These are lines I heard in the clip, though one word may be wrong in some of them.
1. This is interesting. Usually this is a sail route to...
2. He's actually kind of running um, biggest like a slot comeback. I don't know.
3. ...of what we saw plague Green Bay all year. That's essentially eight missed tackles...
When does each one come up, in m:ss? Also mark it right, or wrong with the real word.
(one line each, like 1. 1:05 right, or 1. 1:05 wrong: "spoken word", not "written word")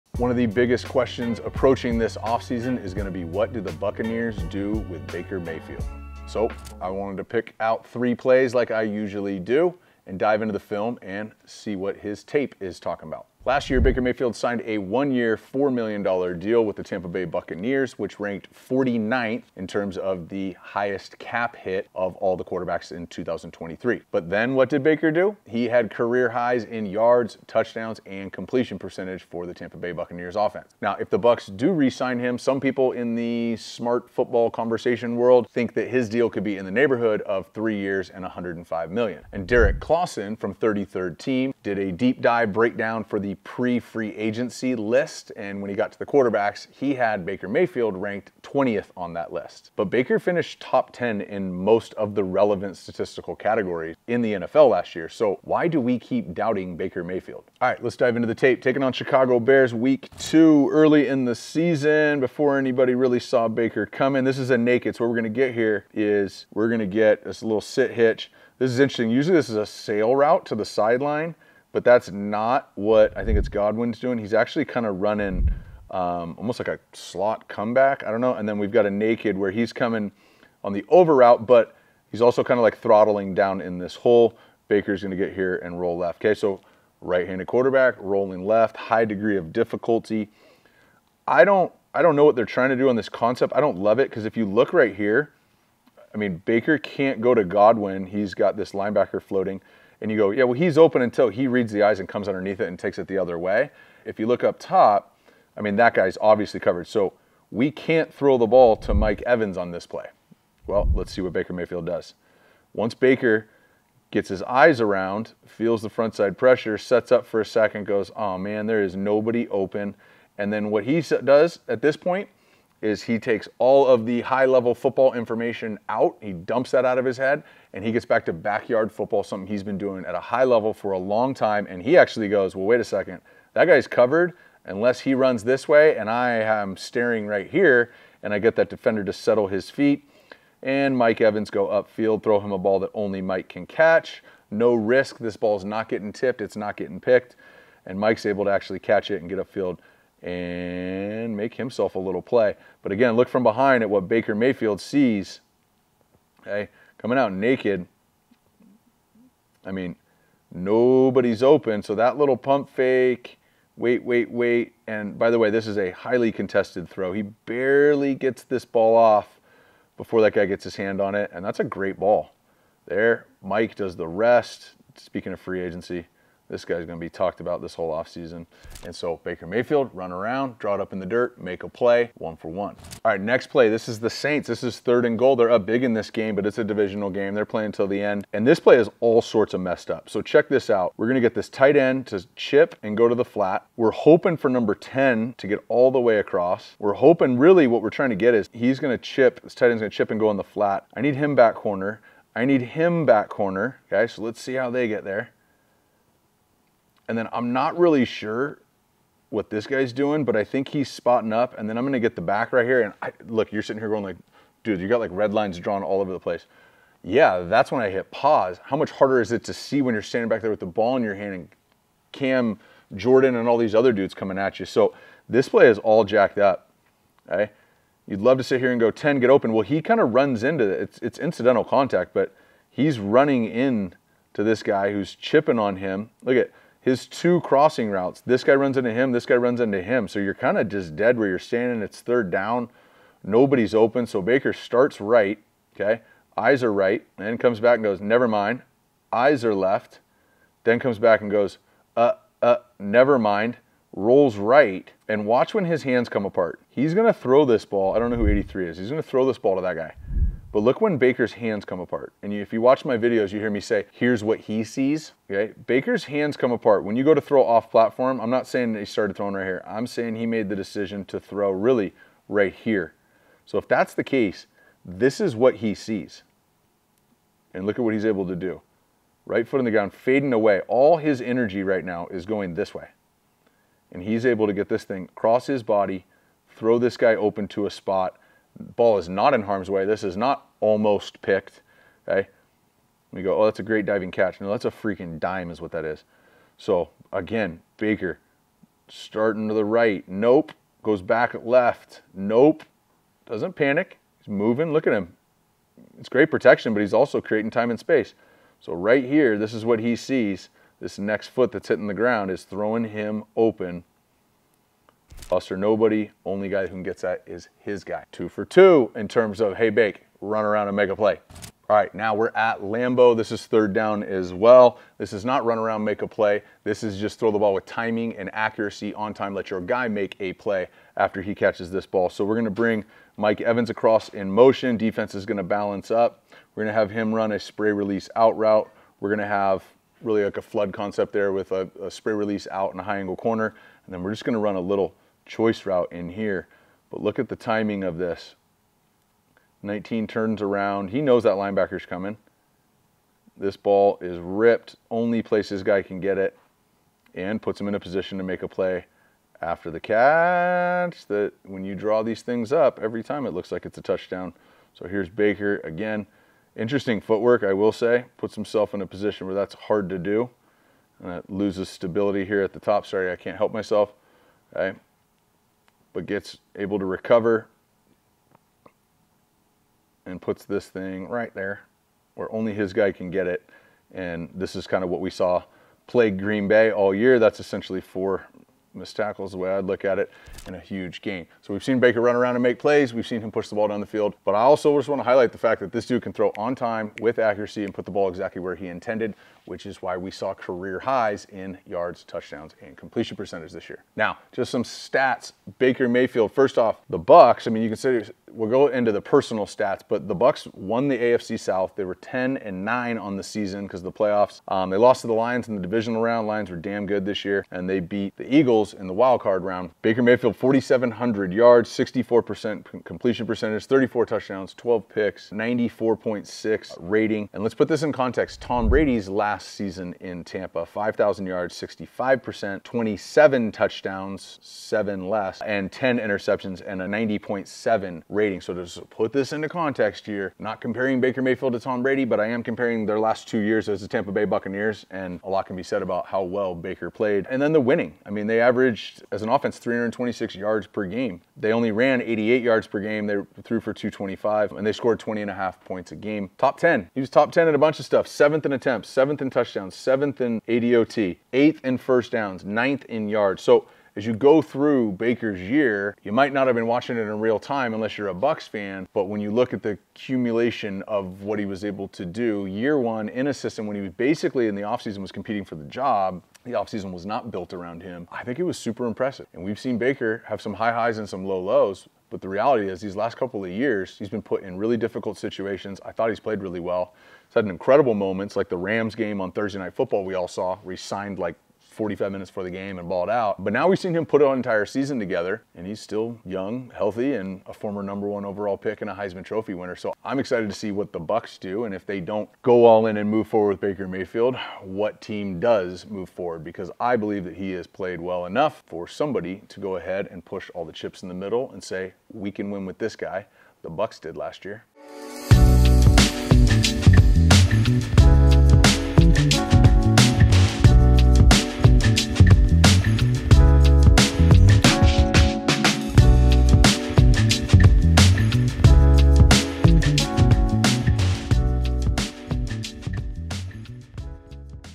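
1. 1:08 right
2. 1:14 wrong: "almost", not "biggest"
3. 6:24 wrong: "four", not "eight".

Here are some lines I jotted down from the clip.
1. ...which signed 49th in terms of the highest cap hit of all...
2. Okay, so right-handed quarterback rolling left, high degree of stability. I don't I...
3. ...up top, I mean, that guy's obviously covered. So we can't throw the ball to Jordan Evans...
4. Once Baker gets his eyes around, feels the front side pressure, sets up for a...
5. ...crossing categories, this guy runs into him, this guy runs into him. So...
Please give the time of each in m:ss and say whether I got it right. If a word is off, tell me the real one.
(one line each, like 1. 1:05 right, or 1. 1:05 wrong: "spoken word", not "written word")
1. 0:17 wrong: "ranked", not "signed"
2. 1:26 wrong: "difficulty", not "stability"
3. 1:44 wrong: "Mike", not "Jordan"
4. 1:52 right
5. 3:57 wrong: "routes", not "categories".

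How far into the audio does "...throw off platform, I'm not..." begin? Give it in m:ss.
4:27.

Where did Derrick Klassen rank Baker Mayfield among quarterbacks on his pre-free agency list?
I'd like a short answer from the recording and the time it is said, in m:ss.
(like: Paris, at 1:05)
20th, at 0:48.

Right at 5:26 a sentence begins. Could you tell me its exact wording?
This is just throw the ball with timing and accuracy on time.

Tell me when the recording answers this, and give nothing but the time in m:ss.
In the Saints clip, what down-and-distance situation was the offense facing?
3:04.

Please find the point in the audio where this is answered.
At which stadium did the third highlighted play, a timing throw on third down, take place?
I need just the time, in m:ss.
5:22.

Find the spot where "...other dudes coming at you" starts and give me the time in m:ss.
3:43.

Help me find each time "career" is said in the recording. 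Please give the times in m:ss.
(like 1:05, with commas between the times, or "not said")
0:25, 6:40.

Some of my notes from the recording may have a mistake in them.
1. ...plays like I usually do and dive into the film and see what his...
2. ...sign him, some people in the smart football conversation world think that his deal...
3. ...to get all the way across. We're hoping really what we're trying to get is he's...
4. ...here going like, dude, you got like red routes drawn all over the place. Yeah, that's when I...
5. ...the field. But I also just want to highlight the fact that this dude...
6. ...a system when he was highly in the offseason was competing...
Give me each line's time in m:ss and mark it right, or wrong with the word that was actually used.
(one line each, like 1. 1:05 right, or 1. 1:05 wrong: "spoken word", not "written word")
1. 0:08 right
2. 0:31 right
3. 3:15 right
4. 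3:33 wrong: "lines", not "routes"
5. 6:33 right
6. 7:53 wrong: "basically", not "highly".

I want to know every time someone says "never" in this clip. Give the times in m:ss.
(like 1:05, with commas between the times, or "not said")
4:08, 4:12.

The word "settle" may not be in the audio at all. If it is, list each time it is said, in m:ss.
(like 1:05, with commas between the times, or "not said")
2:19.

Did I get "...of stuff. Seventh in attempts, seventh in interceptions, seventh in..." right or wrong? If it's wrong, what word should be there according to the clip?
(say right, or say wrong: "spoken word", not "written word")
wrong: "touchdowns", not "interceptions".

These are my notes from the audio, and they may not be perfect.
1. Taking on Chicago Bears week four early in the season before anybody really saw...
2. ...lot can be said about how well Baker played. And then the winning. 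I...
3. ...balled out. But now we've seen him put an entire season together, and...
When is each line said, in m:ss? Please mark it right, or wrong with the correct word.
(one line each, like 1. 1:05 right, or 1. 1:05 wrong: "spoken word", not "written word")
1. 0:58 wrong: "two", not "four"
2. 7:25 right
3. 8:12 right.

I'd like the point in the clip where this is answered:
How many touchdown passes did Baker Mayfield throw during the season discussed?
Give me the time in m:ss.
7:03.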